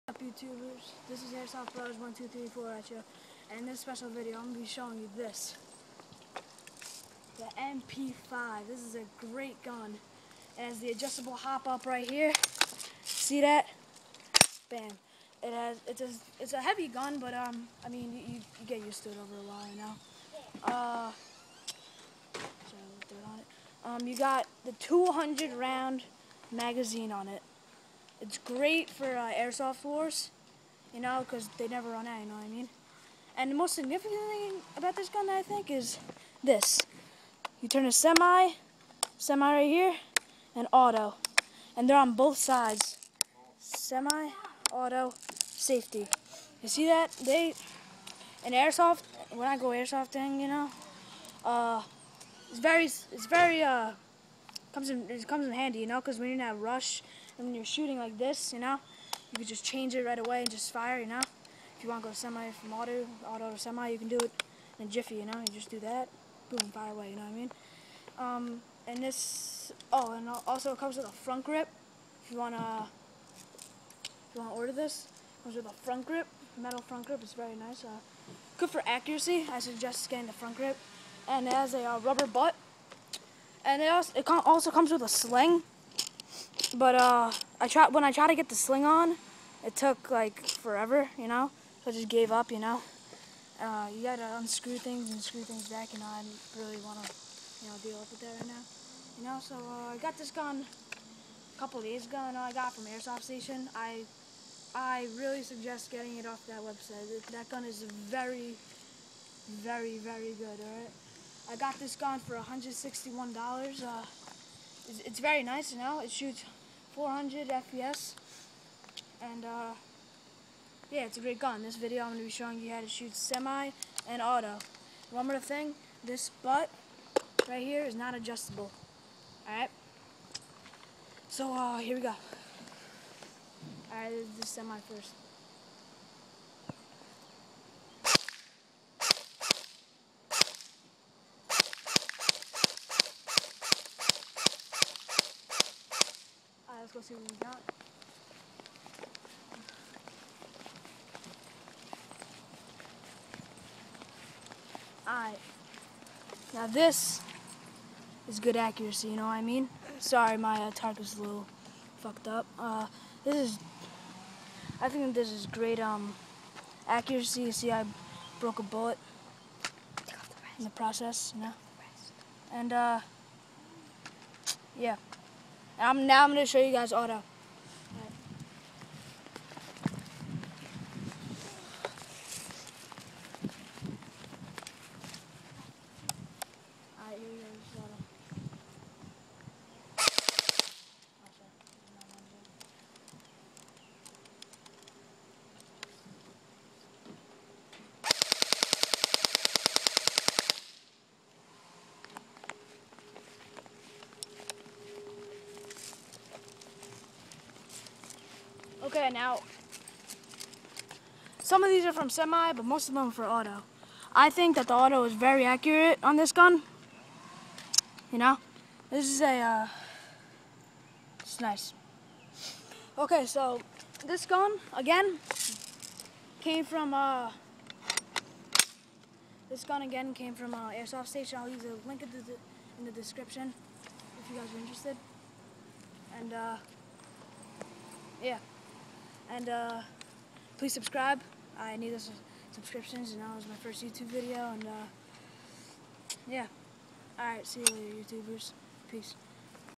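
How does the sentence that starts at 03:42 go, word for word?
Okay, so this gun, again, came from, uh, this gun again came from uh, Airsoft Station.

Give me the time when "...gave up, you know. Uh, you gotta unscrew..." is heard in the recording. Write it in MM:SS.
01:32.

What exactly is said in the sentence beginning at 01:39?
So uh, I got this gun a couple days ago, and I got from Airsoft Station.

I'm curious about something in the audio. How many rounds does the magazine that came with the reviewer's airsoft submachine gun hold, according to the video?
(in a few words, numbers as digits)
200.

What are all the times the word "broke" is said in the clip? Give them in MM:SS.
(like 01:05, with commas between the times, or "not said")
02:48.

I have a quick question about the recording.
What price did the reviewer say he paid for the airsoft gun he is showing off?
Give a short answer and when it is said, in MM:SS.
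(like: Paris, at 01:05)
$161, at 01:52.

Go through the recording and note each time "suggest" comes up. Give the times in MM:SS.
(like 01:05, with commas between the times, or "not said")
01:19, 01:45.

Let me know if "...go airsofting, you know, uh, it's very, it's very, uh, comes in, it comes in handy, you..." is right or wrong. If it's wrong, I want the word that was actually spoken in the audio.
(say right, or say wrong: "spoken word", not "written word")
right.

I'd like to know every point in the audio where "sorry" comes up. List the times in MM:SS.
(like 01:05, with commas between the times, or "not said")
00:22, 02:39.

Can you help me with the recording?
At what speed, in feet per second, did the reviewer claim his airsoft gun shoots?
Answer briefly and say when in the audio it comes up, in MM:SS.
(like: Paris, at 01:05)
400 FPS, at 01:56.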